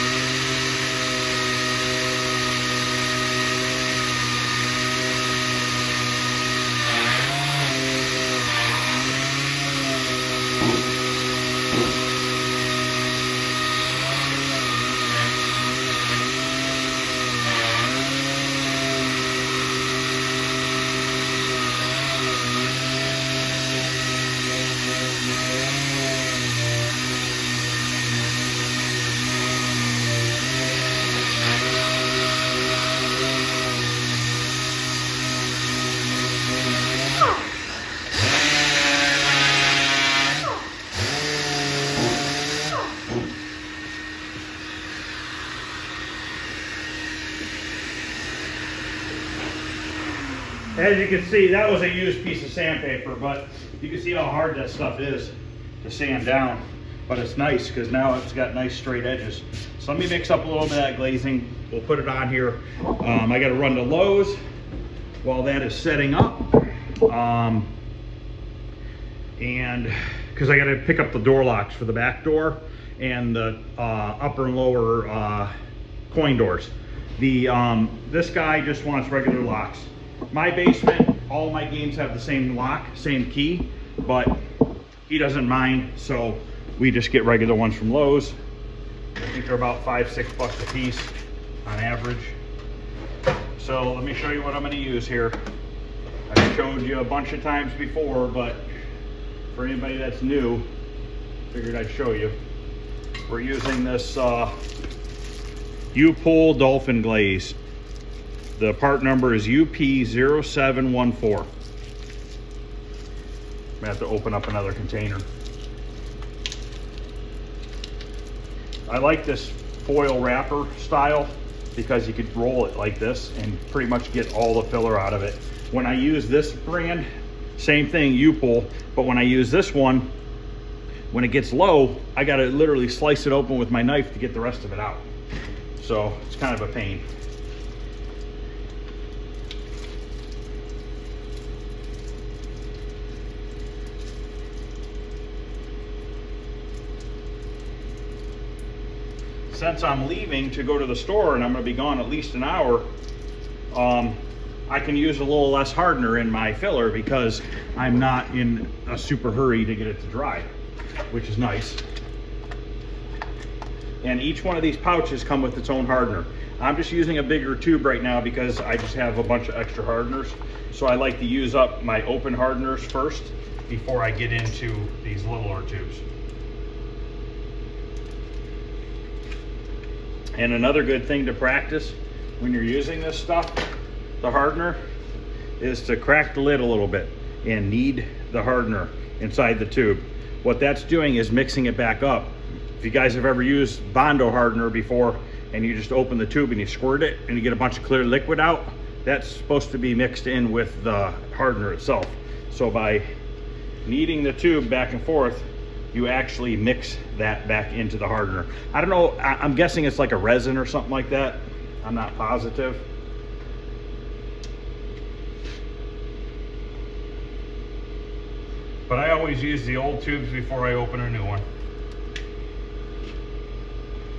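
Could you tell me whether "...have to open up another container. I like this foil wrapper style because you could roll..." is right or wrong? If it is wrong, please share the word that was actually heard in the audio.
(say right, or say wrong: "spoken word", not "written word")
right.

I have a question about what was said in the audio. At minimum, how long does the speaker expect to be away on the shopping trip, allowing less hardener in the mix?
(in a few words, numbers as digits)
1 hour.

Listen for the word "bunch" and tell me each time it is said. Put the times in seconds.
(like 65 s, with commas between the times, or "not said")
97 s, 169 s, 197 s.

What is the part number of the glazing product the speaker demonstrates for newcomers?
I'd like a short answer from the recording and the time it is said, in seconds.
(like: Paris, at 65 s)
UP0714, at 109 s.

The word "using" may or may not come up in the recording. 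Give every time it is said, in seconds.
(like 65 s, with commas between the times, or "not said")
103 s, 166 s, 182 s.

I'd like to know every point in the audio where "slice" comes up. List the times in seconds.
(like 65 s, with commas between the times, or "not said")
132 s.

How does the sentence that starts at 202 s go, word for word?
So by kneading the tube back and forth, you actually mix that back into the hardener.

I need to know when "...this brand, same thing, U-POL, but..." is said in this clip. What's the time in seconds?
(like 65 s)
126 s.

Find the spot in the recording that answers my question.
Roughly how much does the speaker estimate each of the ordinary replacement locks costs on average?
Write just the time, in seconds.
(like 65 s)
89 s.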